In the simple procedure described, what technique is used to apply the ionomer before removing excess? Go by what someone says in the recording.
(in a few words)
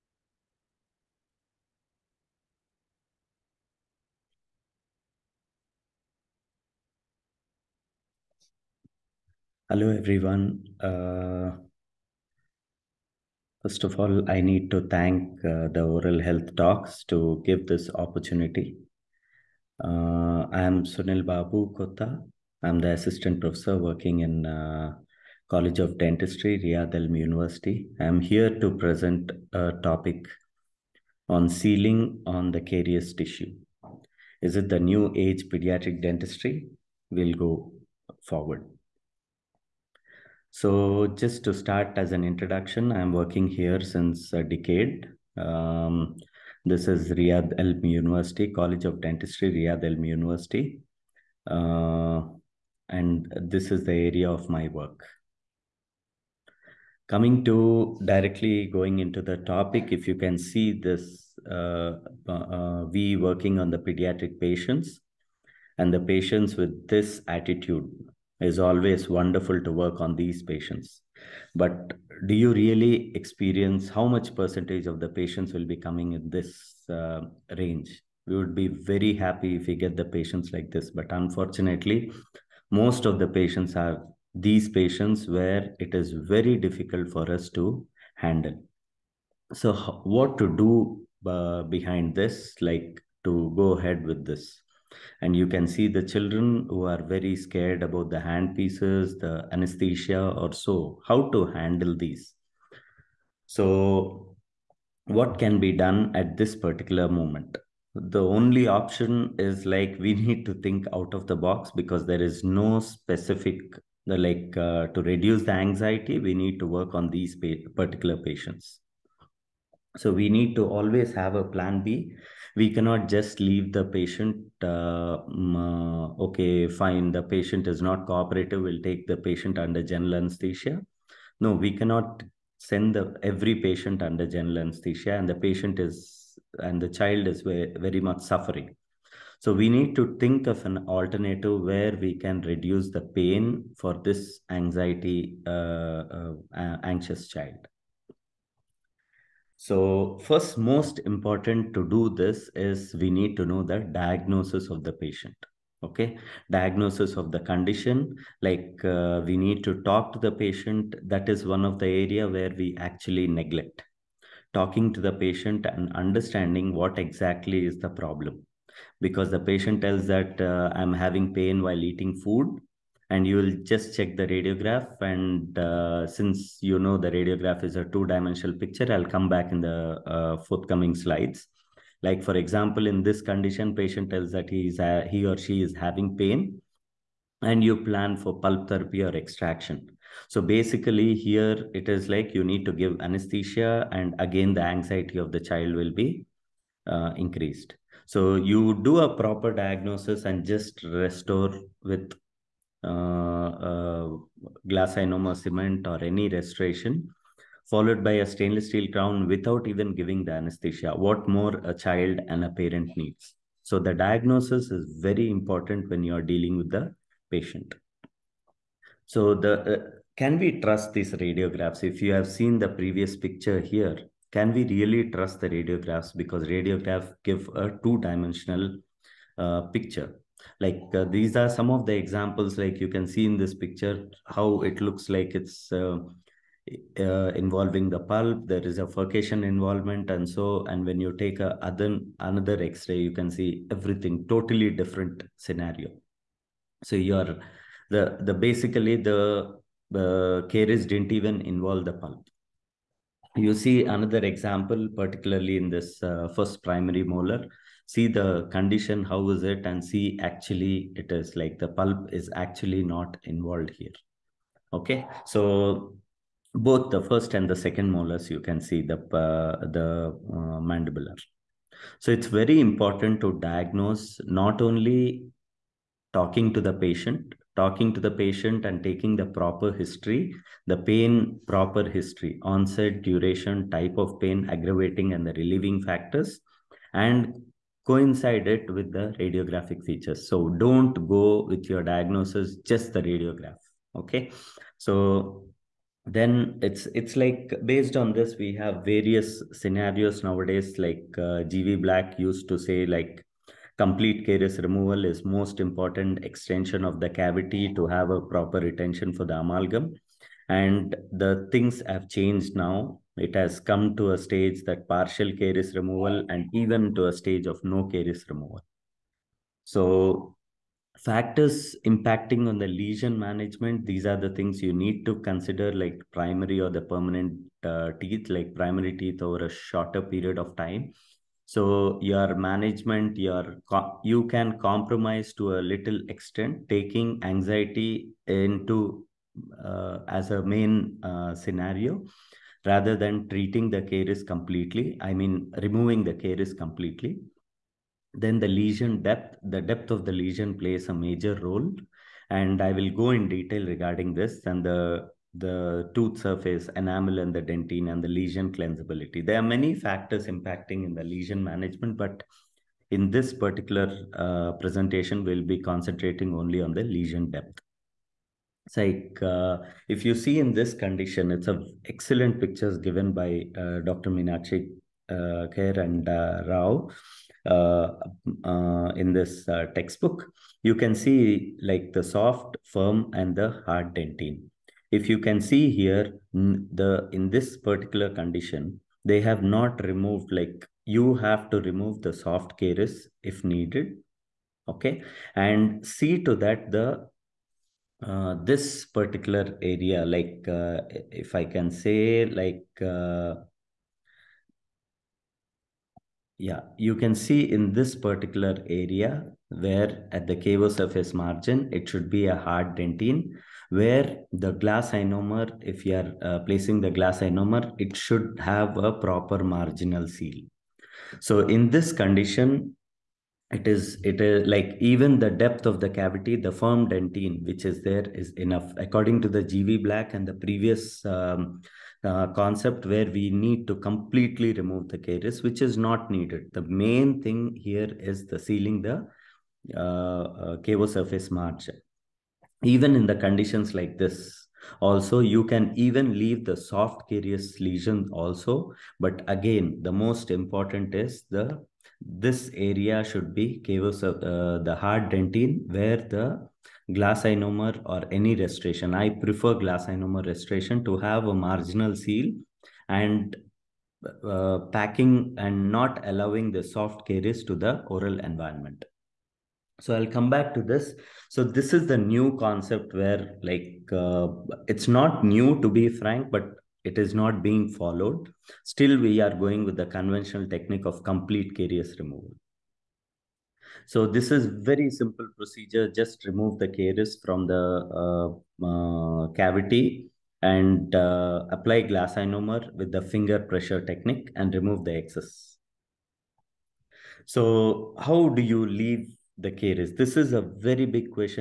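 finger pressure technique.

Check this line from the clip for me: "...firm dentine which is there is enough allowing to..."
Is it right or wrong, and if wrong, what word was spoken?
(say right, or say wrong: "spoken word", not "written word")
wrong: "according", not "allowing".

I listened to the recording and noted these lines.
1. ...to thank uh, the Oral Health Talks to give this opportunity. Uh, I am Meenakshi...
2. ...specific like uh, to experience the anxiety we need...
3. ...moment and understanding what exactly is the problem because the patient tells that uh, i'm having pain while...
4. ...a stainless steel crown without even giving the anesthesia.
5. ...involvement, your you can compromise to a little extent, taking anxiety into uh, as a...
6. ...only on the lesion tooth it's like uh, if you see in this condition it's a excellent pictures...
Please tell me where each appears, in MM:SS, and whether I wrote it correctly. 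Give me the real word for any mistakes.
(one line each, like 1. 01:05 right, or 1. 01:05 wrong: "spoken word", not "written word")
1. 00:14 wrong: "Sunil", not "Meenakshi"
2. 01:52 wrong: "reduce", not "experience"
3. 02:45 wrong: "patient", not "moment"
4. 03:28 right
5. 05:32 wrong: "management", not "involvement"
6. 06:06 wrong: "depth", not "tooth".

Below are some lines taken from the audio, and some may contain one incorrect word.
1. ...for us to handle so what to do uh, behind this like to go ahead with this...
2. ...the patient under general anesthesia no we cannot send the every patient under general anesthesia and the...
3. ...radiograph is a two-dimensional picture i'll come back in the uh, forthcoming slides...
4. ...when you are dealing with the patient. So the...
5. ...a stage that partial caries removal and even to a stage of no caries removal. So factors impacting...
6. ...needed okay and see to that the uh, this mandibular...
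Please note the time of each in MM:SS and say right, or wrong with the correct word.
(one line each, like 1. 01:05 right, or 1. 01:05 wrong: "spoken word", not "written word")
1. 01:27 right
2. 02:09 right
3. 02:57 right
4. 03:35 right
5. 05:14 right
6. 06:33 wrong: "particular", not "mandibular".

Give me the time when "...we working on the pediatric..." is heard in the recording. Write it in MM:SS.
01:02.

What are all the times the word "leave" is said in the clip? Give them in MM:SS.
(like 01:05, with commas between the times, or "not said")
02:03, 07:26, 08:18.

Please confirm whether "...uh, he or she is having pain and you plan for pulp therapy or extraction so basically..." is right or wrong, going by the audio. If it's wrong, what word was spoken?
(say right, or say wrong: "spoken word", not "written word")
right.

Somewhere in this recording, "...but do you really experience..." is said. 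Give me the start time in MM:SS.
01:11.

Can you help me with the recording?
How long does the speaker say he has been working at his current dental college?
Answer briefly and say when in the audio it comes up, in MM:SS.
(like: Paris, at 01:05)
a decade, at 00:44.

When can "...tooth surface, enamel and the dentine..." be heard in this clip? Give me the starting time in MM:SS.
05:55.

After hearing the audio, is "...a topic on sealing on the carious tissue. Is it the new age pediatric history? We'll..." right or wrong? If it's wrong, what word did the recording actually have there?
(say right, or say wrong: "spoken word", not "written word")
wrong: "dentistry", not "history".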